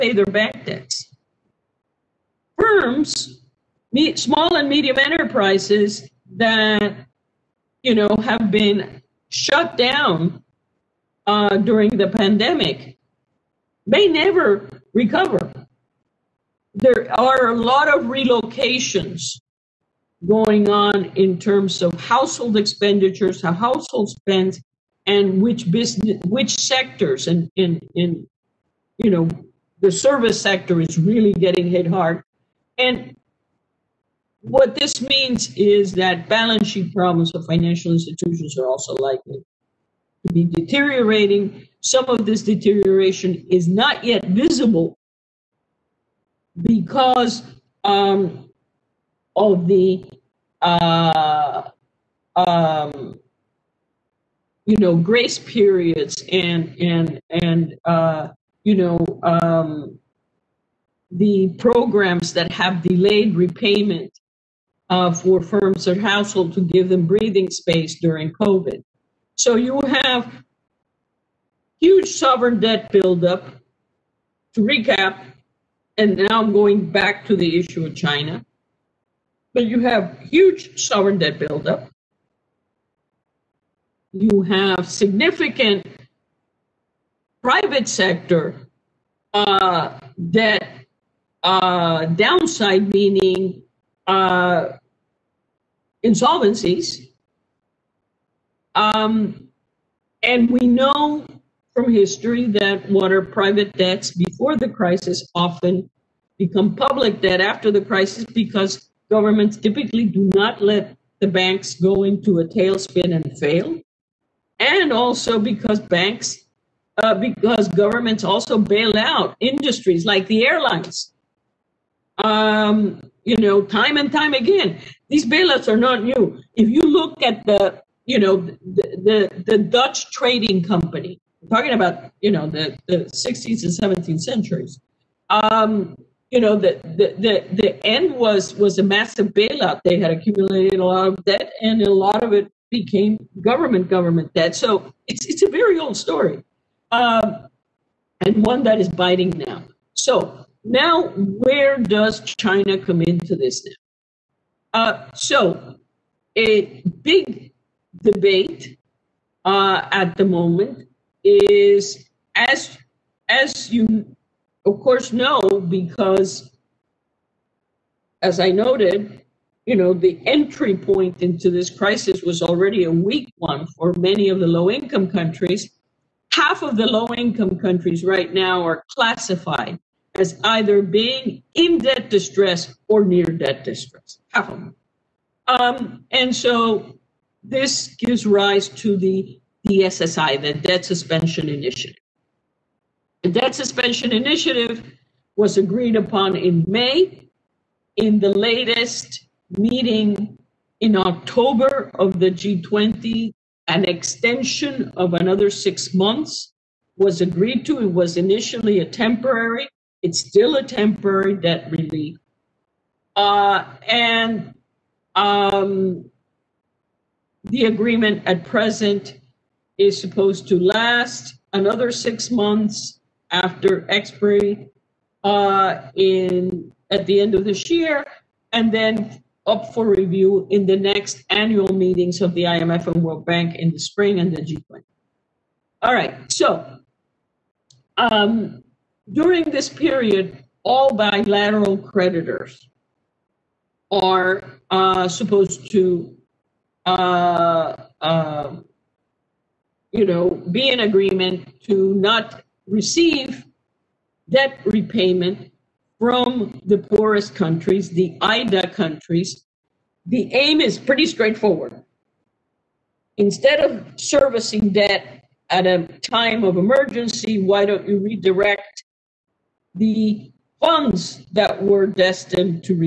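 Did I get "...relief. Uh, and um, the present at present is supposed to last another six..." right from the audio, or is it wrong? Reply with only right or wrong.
wrong.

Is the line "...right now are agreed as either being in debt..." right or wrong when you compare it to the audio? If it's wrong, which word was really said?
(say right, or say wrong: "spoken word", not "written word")
wrong: "classified", not "agreed".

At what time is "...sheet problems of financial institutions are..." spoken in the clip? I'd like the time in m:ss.
0:36.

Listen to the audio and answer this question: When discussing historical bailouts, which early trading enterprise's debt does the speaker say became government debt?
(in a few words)
Dutch trading company.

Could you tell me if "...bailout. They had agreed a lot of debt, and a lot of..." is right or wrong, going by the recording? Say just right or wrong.
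wrong.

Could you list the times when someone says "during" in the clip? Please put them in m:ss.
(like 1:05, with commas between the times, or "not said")
0:11, 1:07, 3:59.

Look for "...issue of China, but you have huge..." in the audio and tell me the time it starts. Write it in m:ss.
1:17.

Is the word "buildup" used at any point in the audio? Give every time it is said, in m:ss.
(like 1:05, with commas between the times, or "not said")
1:12, 1:21.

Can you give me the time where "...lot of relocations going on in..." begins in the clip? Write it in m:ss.
0:17.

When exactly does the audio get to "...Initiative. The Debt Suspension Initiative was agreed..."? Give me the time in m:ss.
3:11.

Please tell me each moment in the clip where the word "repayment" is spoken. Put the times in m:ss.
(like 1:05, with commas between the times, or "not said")
1:03, 4:14.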